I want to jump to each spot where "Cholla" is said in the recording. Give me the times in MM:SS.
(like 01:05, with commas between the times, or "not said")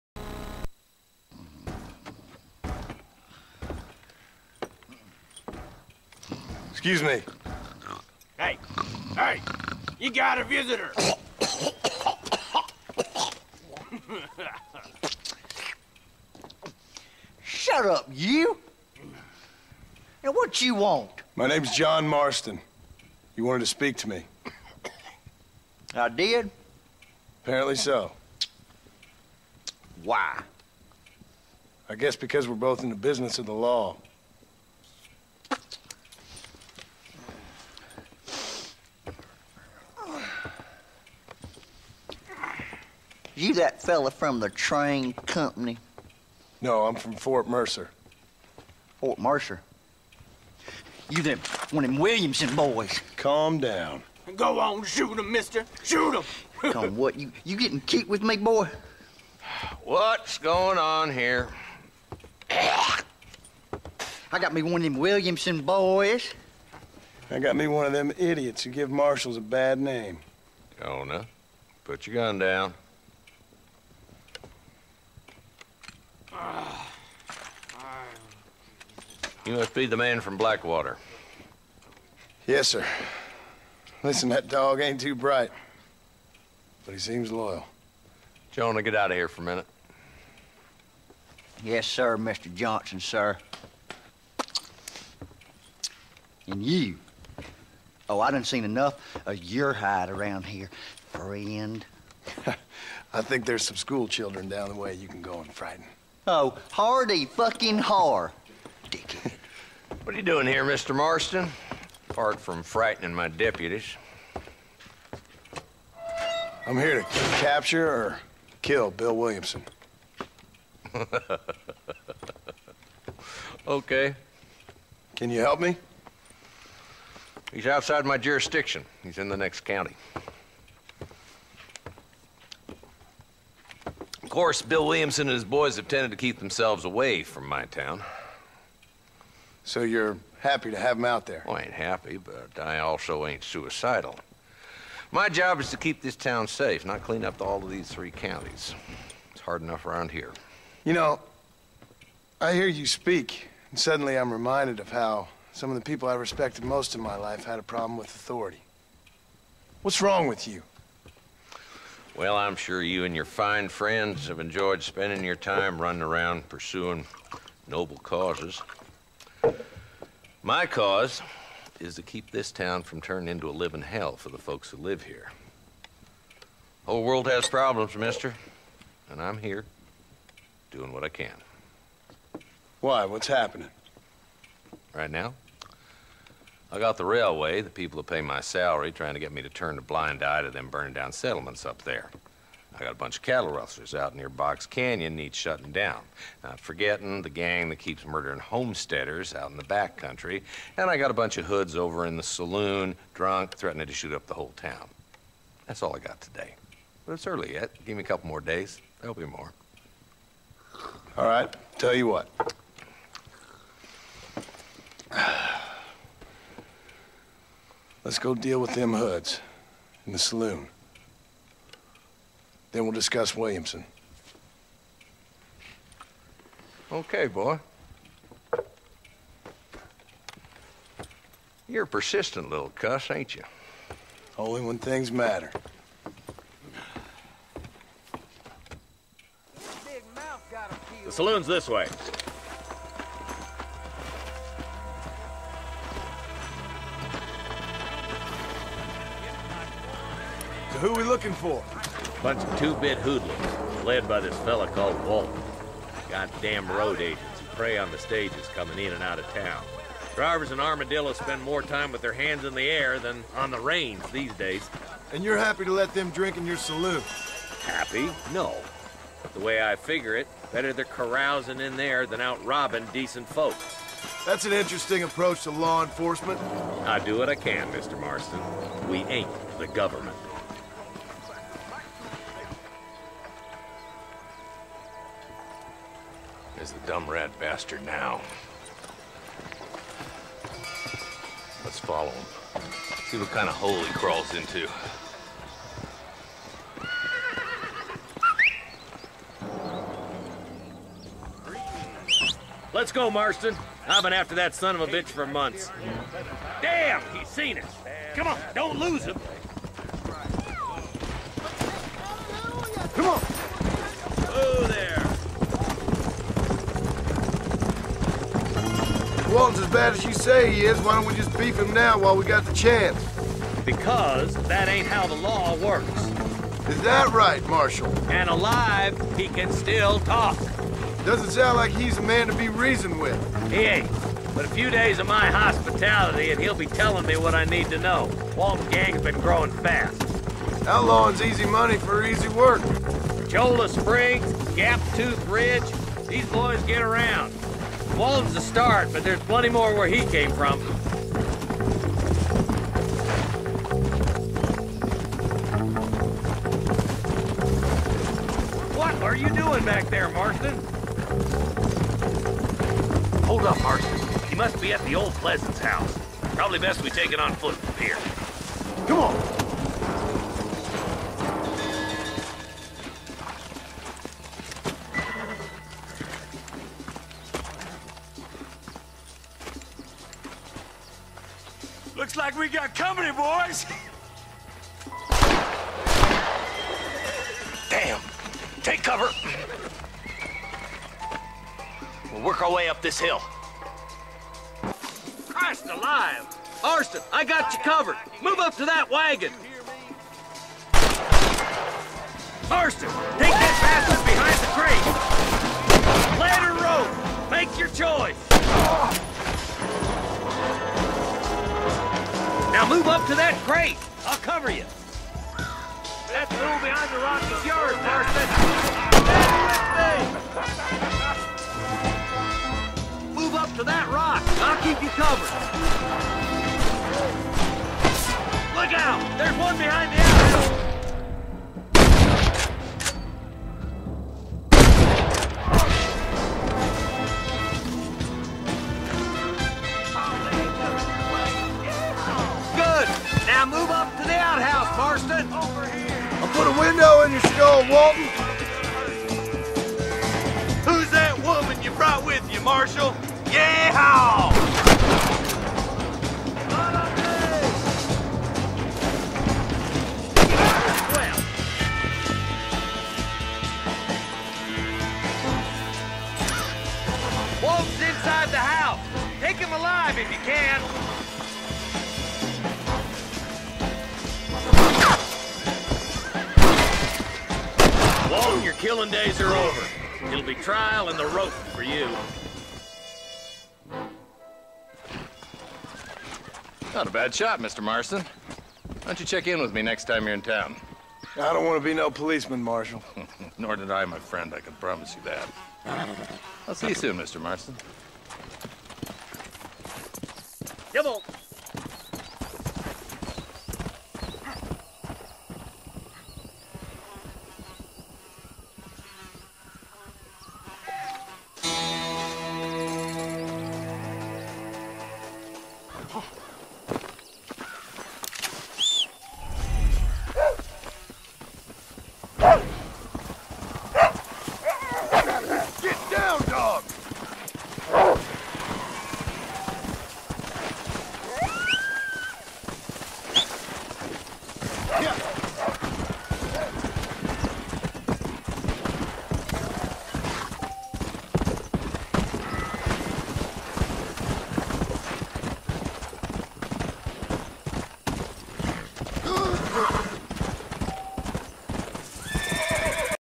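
05:43.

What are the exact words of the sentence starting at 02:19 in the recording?
So you're happy to have him out there?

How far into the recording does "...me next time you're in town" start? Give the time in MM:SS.
08:09.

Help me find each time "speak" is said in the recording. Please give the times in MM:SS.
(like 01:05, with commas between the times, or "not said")
00:23, 02:32.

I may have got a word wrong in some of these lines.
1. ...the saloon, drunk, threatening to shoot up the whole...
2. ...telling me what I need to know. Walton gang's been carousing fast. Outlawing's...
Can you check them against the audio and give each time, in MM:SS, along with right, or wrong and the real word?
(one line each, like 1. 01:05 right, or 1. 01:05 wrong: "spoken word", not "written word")
1. 03:22 right
2. 05:36 wrong: "growing", not "carousing".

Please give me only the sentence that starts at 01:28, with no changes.
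Jonah, get out of here for a minute.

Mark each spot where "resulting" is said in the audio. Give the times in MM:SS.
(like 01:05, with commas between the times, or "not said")
not said.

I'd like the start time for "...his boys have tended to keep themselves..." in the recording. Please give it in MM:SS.
02:15.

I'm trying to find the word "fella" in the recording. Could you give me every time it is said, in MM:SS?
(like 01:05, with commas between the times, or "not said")
00:43, 04:14.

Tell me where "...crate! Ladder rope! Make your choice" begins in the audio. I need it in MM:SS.
06:46.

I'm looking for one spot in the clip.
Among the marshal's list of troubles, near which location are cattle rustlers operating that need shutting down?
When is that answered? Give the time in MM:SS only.
03:14.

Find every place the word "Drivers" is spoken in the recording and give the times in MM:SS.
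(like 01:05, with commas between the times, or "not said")
04:20.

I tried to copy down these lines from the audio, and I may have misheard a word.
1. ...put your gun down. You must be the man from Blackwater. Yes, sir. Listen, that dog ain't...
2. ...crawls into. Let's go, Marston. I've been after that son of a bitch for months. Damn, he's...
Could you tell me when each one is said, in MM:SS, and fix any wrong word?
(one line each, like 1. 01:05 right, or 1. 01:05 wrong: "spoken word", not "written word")
1. 01:11 right
2. 04:53 right.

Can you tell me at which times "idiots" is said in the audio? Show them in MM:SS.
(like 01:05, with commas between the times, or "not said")
01:08.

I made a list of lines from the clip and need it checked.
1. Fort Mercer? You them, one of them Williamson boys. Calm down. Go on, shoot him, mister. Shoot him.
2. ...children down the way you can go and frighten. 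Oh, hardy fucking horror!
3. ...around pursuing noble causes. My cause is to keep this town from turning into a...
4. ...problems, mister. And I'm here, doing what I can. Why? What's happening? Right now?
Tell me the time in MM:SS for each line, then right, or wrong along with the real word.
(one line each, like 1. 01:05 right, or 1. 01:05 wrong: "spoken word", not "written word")
1. 00:48 right
2. 01:44 right
3. 02:46 right
4. 02:57 right.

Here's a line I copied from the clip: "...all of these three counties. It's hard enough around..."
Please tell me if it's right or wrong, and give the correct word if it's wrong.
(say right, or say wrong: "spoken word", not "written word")
right.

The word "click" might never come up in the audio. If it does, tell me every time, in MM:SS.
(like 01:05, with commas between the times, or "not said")
not said.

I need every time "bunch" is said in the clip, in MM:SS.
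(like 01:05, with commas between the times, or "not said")
03:12, 03:21, 04:12.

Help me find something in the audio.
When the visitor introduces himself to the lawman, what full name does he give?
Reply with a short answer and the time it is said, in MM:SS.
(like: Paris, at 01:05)
John Marston, at 00:21.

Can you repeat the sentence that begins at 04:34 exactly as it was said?
That's an interesting approach to law enforcement.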